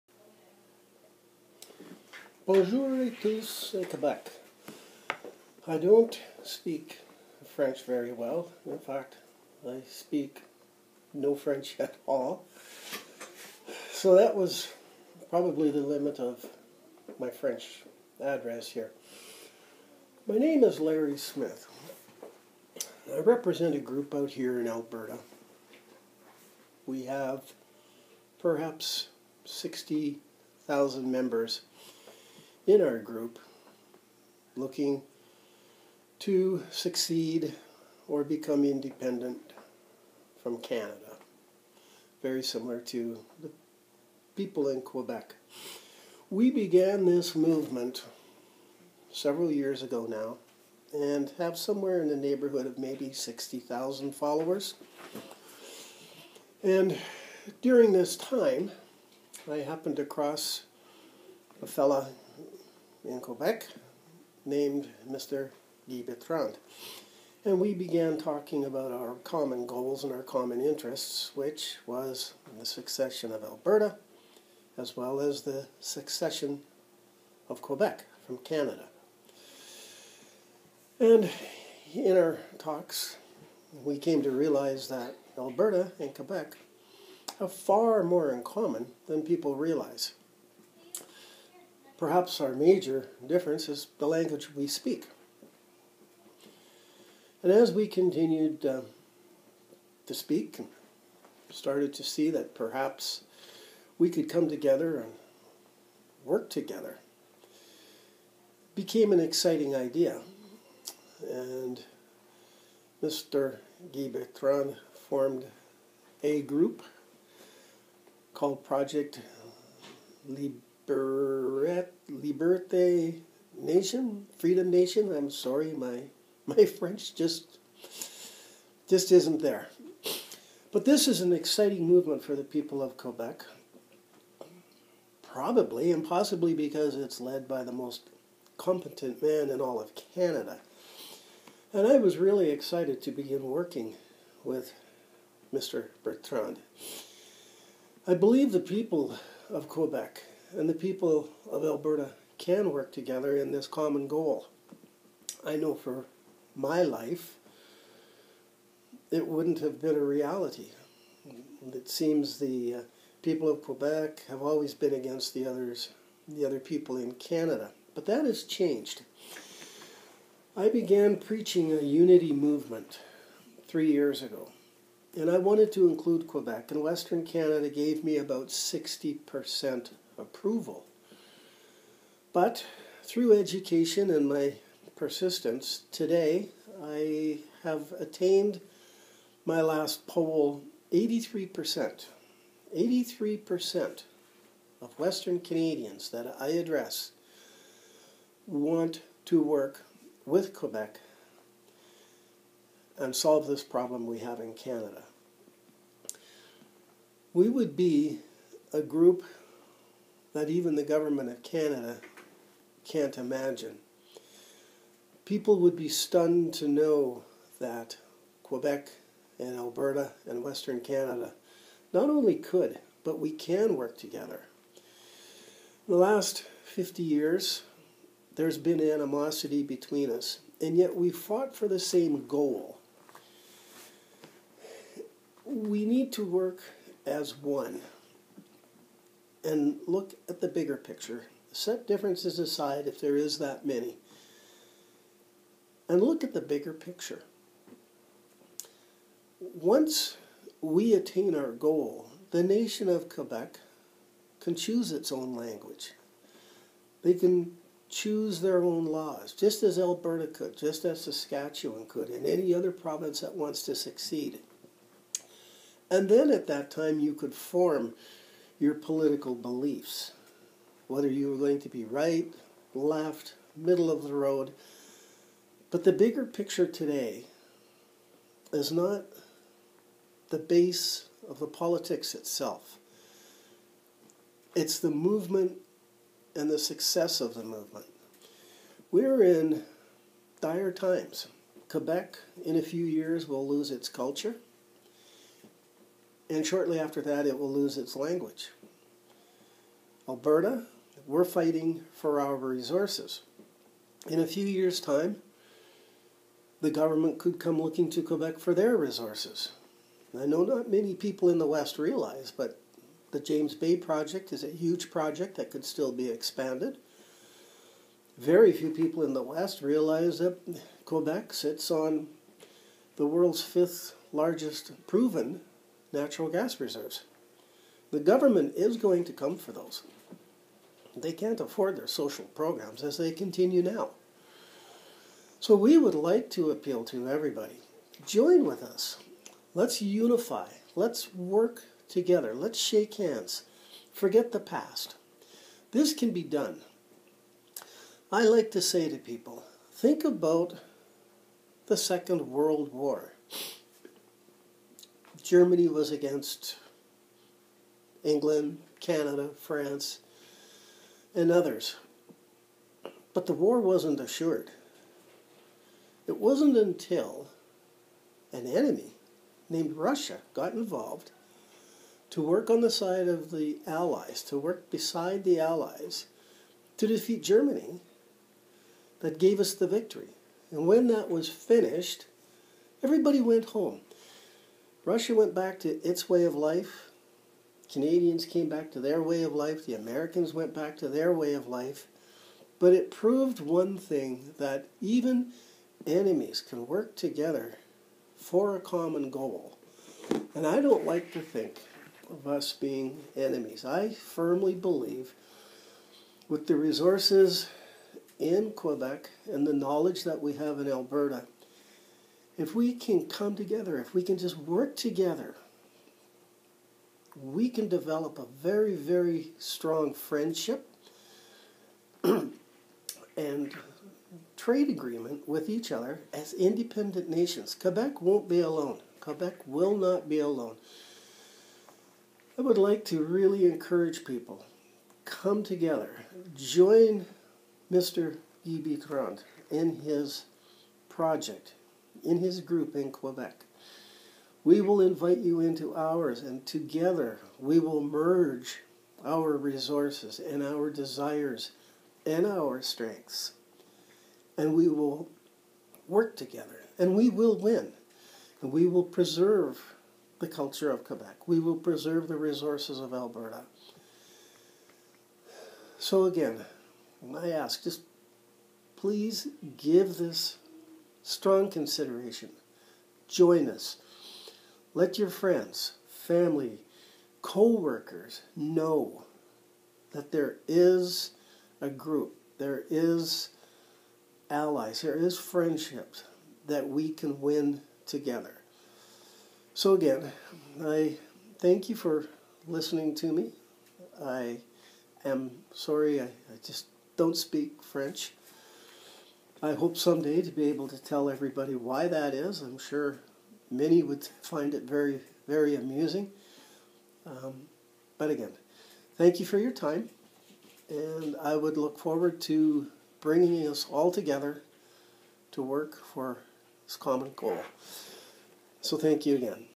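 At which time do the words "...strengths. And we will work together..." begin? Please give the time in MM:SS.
07:32.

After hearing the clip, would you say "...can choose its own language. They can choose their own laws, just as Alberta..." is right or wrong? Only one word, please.
right.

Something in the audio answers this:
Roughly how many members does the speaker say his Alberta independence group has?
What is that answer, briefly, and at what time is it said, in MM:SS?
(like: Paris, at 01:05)
60,000, at 00:29.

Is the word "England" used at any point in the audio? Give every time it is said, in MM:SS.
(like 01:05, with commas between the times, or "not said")
05:58.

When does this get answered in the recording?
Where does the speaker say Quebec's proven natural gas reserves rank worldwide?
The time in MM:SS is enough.
05:23.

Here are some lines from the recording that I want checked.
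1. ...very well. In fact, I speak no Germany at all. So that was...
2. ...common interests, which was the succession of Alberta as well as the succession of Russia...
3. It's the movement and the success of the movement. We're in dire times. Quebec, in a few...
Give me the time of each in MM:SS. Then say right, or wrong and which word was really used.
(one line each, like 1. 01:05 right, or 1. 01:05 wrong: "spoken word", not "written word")
1. 00:07 wrong: "French", not "Germany"
2. 01:10 wrong: "Quebec", not "Russia"
3. 04:44 right.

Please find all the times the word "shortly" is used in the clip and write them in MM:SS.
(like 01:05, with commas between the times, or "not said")
04:56.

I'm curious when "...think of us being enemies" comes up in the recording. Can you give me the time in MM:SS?
06:41.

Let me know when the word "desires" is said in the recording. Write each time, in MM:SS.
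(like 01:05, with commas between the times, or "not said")
07:30.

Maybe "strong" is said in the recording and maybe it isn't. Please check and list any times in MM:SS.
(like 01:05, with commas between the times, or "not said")
06:59, 07:51.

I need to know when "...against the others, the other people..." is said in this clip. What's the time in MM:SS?
02:44.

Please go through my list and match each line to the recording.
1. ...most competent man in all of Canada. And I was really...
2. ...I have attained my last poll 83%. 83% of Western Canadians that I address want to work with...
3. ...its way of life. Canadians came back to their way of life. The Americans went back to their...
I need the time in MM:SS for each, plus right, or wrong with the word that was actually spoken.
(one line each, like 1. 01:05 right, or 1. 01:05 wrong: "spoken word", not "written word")
1. 02:17 right
2. 03:06 right
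3. 06:25 right.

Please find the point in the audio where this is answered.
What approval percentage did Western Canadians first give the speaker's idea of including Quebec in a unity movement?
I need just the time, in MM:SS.
02:58.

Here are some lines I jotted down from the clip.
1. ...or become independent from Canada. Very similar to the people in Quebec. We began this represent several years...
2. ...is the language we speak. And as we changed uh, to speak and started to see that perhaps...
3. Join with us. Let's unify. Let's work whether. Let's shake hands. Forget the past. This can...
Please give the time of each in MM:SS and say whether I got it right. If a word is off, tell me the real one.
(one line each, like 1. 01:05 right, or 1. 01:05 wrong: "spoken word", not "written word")
1. 00:38 wrong: "movement", not "represent"
2. 01:33 wrong: "continued", not "changed"
3. 05:38 wrong: "together", not "whether".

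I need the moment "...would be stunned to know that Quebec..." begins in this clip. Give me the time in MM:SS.
03:35.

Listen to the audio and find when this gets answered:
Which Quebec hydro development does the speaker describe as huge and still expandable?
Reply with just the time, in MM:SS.
05:13.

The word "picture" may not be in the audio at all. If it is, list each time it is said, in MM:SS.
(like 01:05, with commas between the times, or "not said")
04:00, 04:06, 04:36.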